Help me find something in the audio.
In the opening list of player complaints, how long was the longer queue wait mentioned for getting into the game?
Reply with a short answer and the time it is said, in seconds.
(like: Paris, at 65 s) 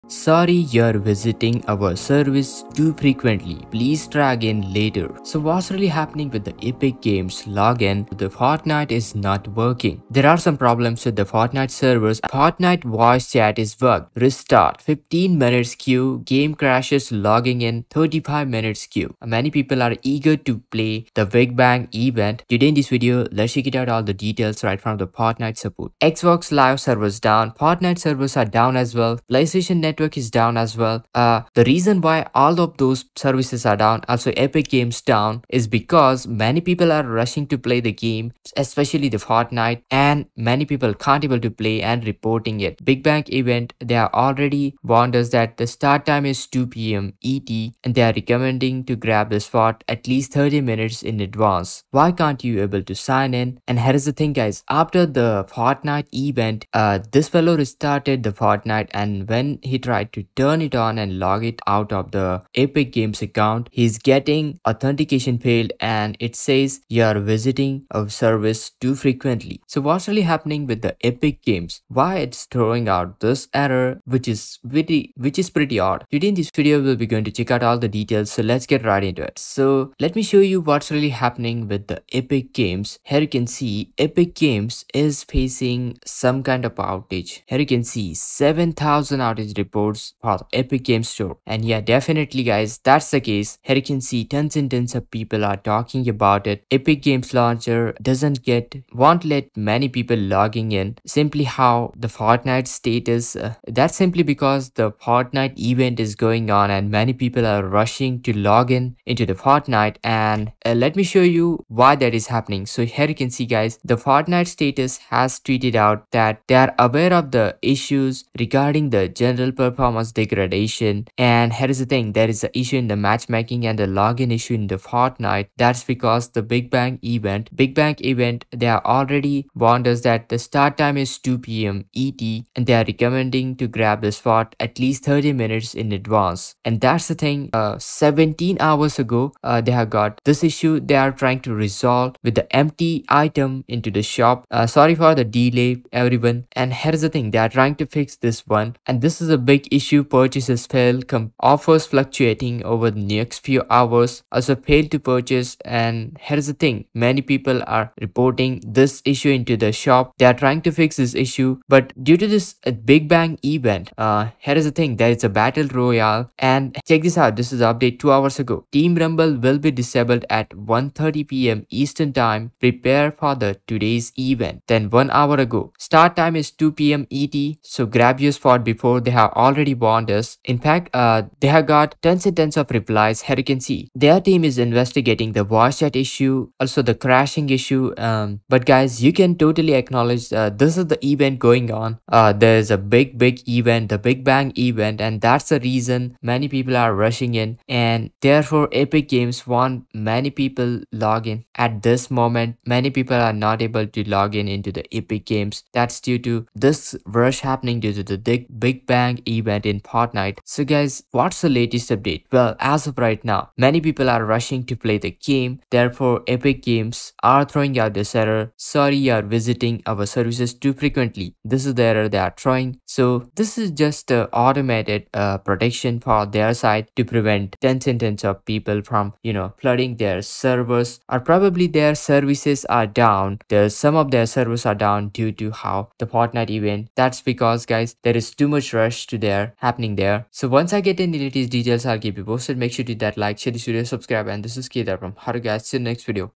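35 minutes, at 17 s.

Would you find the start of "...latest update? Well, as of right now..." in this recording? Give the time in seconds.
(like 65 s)
211 s.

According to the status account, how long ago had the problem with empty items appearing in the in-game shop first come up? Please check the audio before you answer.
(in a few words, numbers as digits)
17 hours ago.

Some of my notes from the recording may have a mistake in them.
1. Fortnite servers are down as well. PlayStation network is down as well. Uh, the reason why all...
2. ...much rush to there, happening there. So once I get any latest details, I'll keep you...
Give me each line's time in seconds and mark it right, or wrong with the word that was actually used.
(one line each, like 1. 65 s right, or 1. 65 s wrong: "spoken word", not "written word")
1. 27 s right
2. 238 s right.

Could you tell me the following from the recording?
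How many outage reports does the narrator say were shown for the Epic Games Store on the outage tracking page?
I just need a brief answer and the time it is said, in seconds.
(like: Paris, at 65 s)
7000, at 88 s.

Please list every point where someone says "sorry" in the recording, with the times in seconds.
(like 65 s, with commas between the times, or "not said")
0 s, 144 s, 218 s.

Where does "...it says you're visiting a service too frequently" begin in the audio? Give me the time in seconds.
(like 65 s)
66 s.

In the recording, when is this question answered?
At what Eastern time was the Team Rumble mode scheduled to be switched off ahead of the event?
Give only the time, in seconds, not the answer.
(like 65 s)
170 s.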